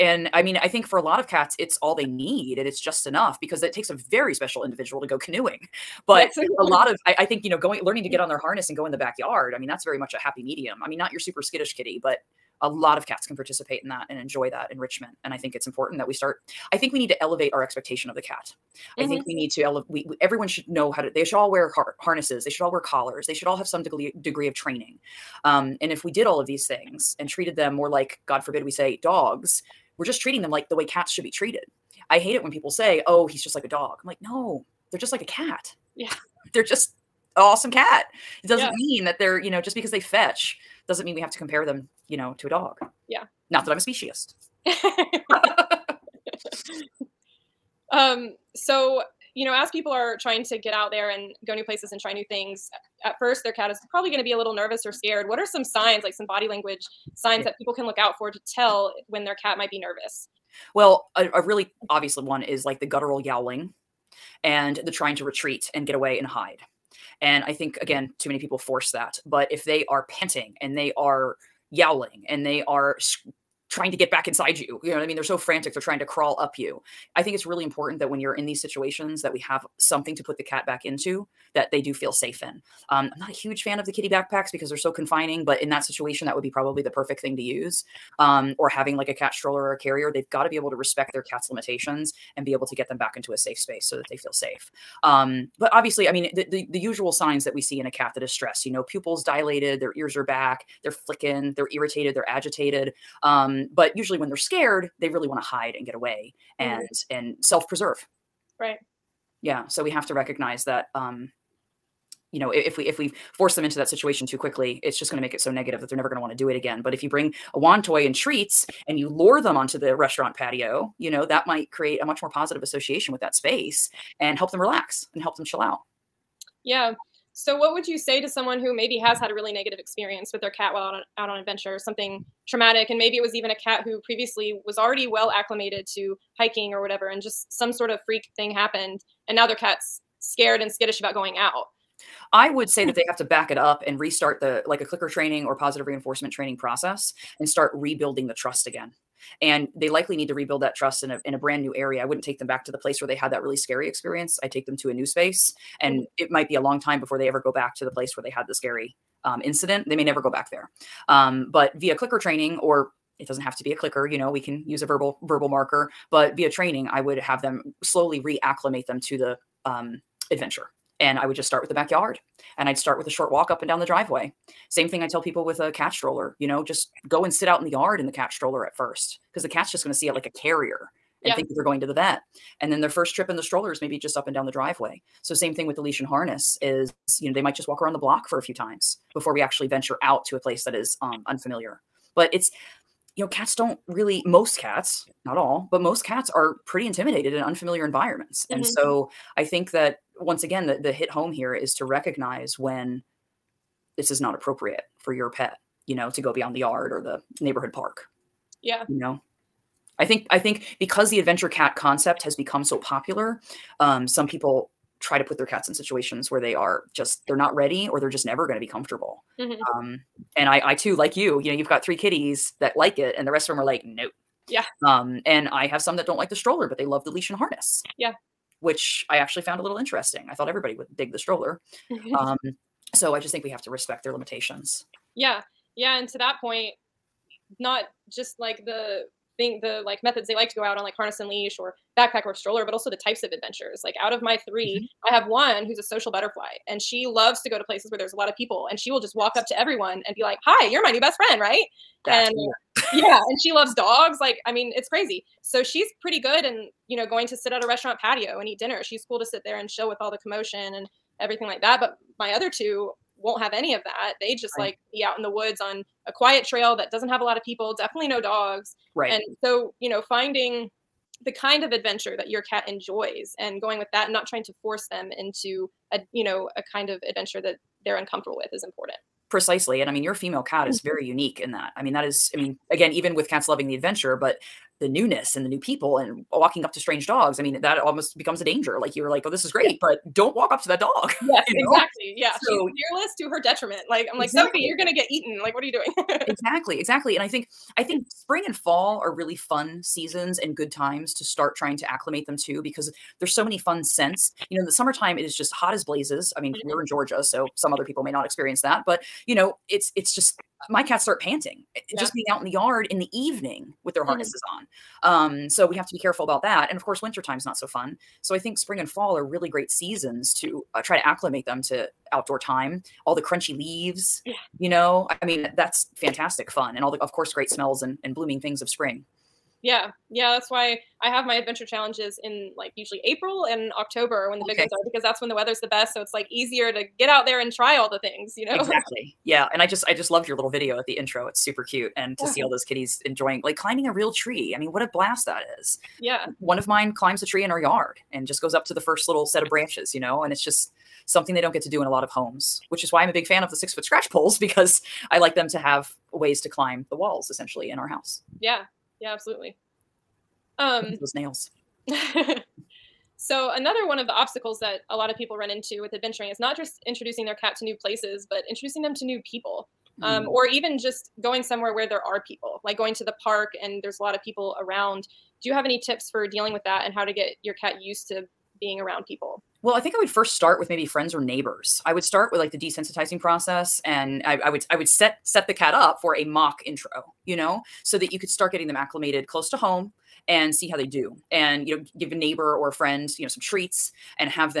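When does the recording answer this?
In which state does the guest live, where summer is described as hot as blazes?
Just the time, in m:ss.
5:06.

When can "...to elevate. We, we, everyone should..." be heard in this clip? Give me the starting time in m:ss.
0:19.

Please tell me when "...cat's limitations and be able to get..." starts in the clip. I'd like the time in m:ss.
1:31.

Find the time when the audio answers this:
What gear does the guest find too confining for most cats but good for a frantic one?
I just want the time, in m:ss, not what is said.
1:23.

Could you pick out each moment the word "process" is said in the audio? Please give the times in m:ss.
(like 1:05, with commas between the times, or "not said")
2:26, 6:23.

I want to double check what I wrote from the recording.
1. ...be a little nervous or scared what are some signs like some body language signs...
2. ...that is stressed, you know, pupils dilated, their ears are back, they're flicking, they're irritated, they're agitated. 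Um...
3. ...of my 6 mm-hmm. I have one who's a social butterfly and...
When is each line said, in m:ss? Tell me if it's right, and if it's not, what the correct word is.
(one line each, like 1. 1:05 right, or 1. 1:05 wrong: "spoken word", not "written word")
1. 0:54 right
2. 1:38 right
3. 4:04 wrong: "3", not "6".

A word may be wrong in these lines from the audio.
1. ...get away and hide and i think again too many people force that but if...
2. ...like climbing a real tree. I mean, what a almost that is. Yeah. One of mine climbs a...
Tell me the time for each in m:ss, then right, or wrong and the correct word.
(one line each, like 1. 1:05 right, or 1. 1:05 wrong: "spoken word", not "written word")
1. 1:05 right
2. 5:43 wrong: "blast", not "almost".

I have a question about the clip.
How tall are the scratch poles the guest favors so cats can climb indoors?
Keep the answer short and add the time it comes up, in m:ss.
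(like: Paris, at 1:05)
6 feet, at 5:53.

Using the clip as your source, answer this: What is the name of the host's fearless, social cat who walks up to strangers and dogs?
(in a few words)
Sophie.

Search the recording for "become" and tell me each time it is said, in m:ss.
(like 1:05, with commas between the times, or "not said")
3:32, 4:48.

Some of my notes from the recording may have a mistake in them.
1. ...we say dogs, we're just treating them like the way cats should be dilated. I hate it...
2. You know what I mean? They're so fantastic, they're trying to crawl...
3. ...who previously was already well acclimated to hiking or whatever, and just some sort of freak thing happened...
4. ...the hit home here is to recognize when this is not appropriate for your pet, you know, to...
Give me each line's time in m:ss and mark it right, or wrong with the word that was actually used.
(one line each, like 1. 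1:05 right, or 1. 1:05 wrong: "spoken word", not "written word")
1. 0:28 wrong: "treated", not "dilated"
2. 1:14 wrong: "frantic", not "fantastic"
3. 2:13 right
4. 3:20 right.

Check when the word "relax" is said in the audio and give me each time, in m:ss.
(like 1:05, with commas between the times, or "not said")
2:04.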